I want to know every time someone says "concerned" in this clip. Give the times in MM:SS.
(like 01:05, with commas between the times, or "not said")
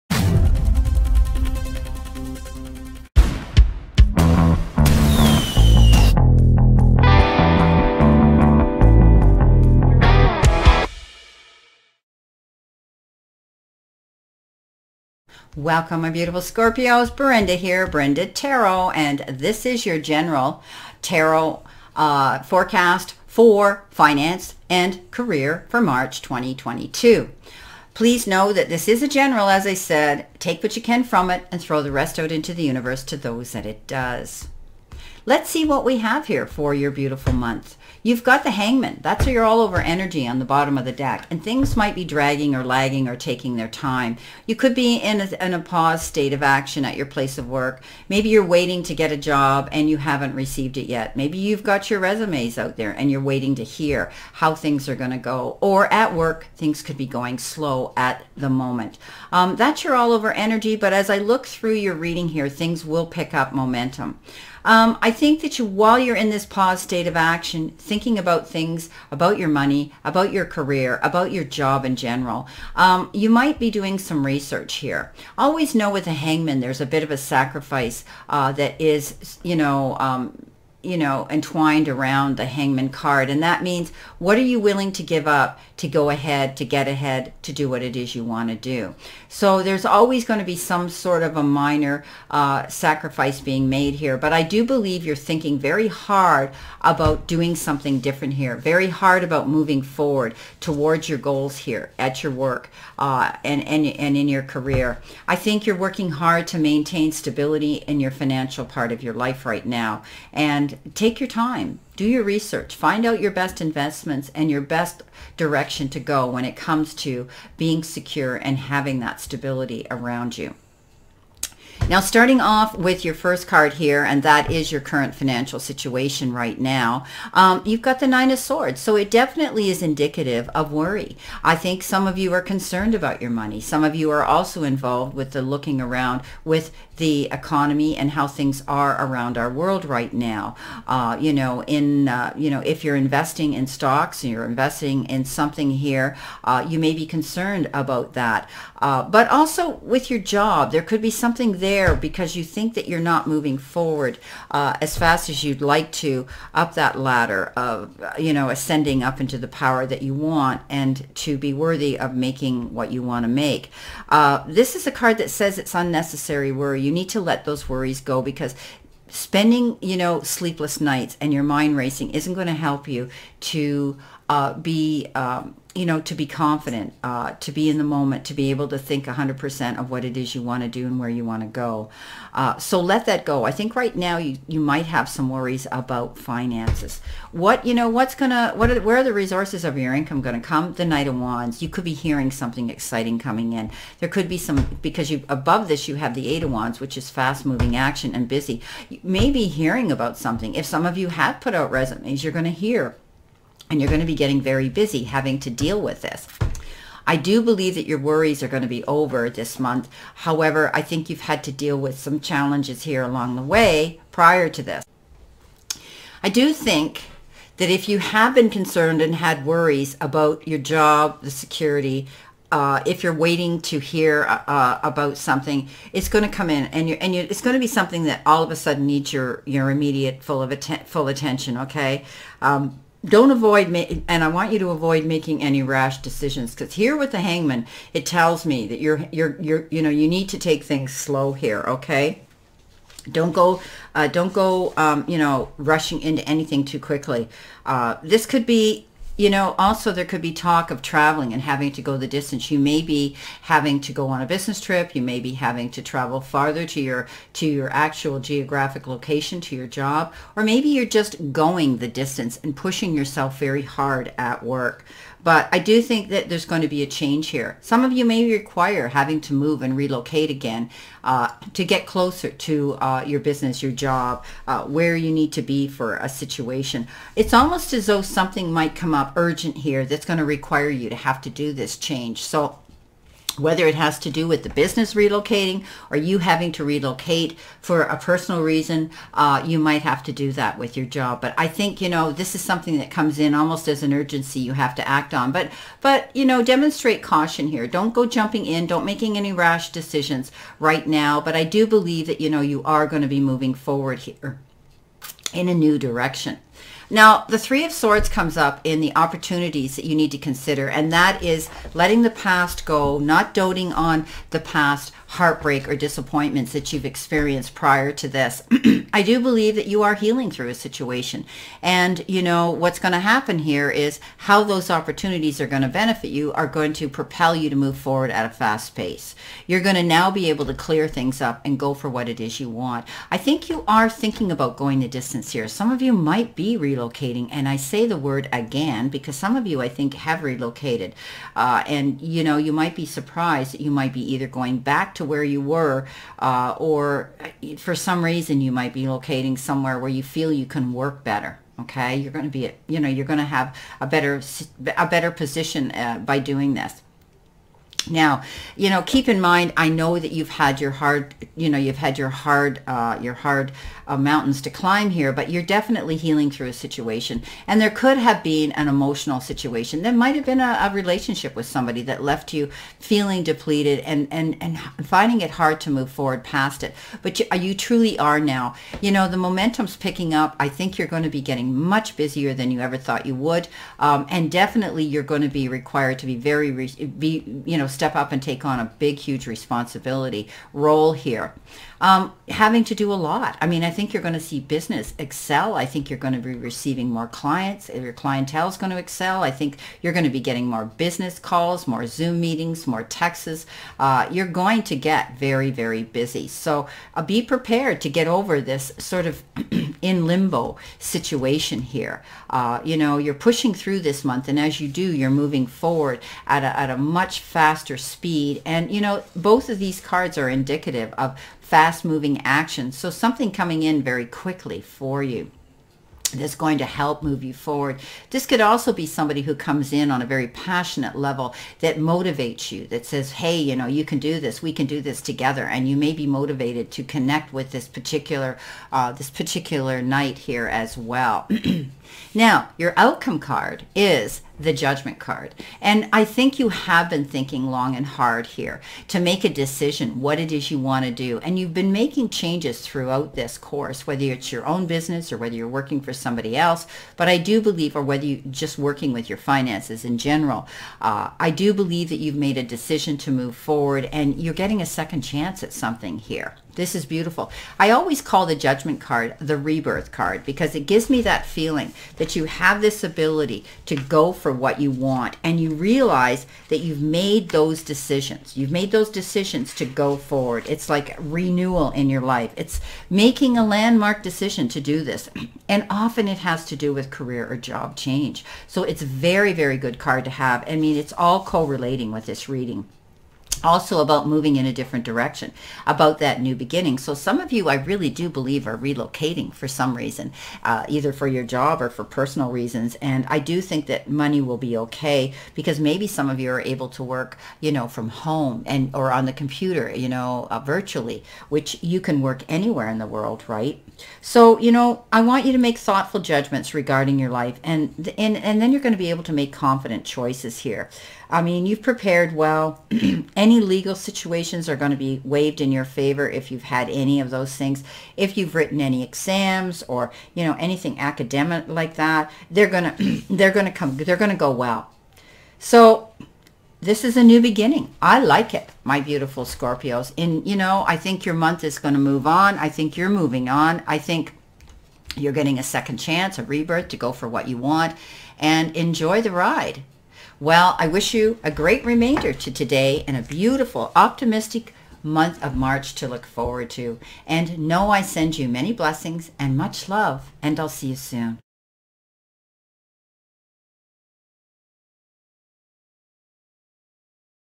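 02:12, 02:27, 03:38.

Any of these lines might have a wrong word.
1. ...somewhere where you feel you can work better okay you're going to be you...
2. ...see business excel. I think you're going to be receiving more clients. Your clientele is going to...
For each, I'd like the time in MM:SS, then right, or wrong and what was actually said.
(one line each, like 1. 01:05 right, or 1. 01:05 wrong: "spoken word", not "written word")
1. 05:49 right
2. 06:34 right.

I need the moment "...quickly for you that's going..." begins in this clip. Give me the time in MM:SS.
07:04.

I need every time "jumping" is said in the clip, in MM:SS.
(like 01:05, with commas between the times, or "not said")
04:58.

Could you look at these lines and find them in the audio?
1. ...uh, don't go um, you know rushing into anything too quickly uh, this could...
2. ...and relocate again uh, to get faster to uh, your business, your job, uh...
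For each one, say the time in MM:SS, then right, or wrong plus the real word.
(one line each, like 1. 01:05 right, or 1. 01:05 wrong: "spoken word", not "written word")
1. 04:03 right
2. 04:29 wrong: "closer", not "faster".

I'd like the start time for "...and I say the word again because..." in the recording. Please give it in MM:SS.
05:37.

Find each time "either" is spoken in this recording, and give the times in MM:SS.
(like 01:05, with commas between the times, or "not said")
05:44, 08:20.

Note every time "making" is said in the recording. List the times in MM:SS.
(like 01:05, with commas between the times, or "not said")
02:42, 03:55, 04:58, 07:31, 08:02.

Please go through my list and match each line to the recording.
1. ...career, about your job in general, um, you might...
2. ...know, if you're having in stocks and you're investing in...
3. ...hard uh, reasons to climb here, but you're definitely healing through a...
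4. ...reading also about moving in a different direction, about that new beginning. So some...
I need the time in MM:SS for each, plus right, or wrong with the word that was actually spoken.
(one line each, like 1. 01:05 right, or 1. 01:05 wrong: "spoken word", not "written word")
1. 01:10 right
2. 02:22 wrong: "investing", not "having"
3. 06:03 wrong: "mountains", not "reasons"
4. 08:12 right.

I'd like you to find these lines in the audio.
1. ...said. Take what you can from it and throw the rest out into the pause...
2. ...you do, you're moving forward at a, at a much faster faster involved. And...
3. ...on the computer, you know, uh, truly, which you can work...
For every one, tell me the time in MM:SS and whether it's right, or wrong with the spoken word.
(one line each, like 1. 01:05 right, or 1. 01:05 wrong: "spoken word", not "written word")
1. 00:29 wrong: "universe", not "pause"
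2. 06:54 wrong: "speed", not "involved"
3. 08:28 wrong: "virtually", not "truly".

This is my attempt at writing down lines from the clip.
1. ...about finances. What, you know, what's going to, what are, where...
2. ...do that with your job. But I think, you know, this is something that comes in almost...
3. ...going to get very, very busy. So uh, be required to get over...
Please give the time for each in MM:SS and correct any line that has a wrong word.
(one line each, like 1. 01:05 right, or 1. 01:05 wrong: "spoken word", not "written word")
1. 03:05 right
2. 04:50 right
3. 06:44 wrong: "prepared", not "required".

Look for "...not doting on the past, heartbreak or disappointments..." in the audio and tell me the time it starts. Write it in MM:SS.
05:12.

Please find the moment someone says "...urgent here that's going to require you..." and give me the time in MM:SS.
04:39.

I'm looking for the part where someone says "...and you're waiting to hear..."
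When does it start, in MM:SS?
00:52.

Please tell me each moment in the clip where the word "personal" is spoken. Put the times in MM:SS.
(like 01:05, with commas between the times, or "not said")
04:47, 08:21.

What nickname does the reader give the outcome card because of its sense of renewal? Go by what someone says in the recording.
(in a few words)
The rebirth card.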